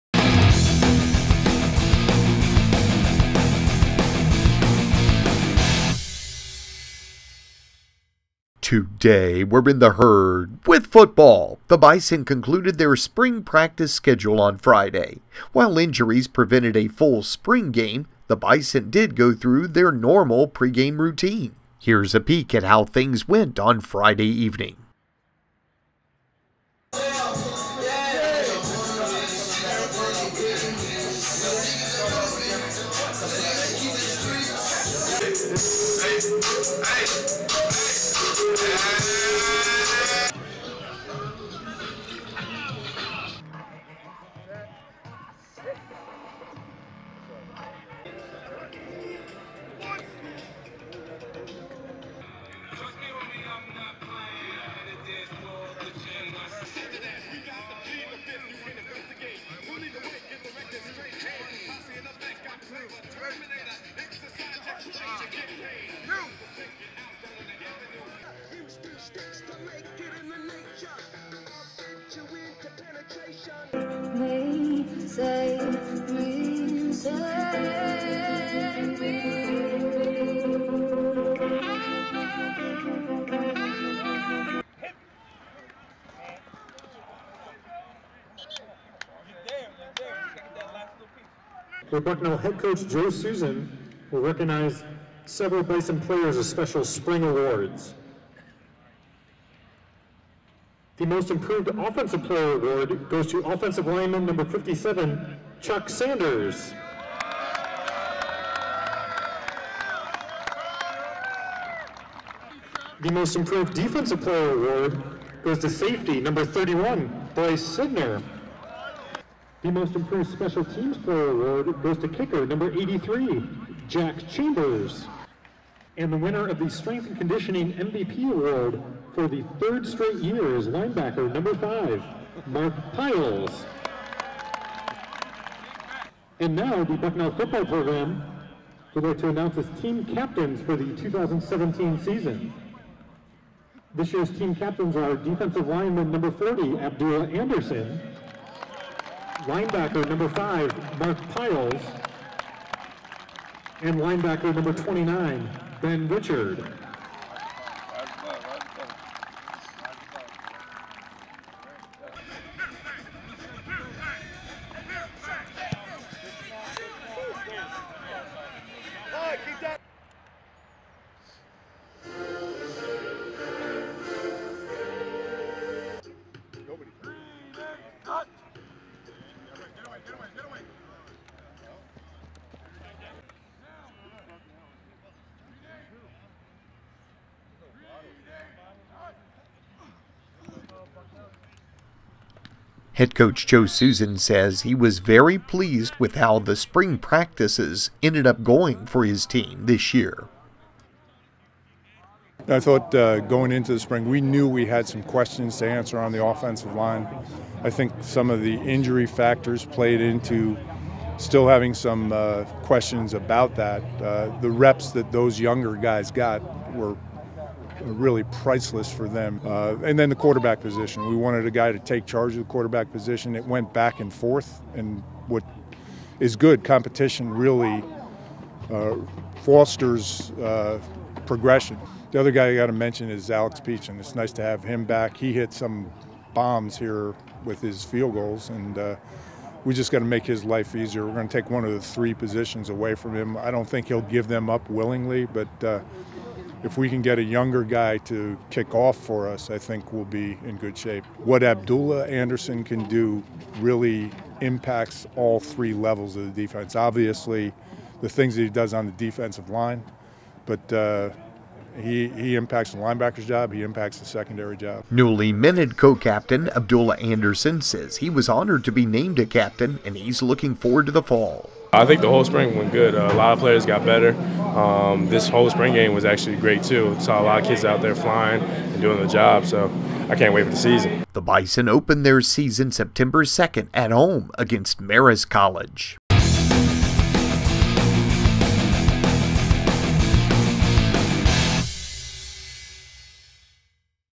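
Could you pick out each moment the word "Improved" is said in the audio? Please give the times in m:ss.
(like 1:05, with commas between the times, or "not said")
1:41, 1:53, 1:59.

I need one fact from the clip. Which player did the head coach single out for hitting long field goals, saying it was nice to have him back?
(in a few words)
Alex Peach.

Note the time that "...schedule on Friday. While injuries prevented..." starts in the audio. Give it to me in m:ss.
0:13.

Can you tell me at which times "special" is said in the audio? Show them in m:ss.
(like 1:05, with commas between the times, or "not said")
1:36, 2:00.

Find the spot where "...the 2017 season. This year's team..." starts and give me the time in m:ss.
2:20.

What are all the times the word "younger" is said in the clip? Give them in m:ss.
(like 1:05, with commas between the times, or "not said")
3:35, 4:07.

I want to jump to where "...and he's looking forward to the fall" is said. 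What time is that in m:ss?
4:29.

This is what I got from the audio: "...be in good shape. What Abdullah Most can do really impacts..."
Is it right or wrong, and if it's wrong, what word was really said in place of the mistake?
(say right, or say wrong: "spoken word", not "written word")
wrong: "Anderson", not "Most".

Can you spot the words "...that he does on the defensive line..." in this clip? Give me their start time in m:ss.
4:18.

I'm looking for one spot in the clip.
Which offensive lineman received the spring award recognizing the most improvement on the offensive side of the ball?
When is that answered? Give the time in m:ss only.
1:45.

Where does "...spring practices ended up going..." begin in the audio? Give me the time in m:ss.
3:16.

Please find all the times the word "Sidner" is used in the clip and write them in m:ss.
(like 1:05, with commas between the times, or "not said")
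1:57.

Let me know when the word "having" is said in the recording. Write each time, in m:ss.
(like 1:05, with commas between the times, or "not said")
3:31.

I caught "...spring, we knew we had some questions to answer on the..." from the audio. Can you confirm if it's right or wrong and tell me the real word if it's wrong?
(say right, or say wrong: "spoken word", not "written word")
right.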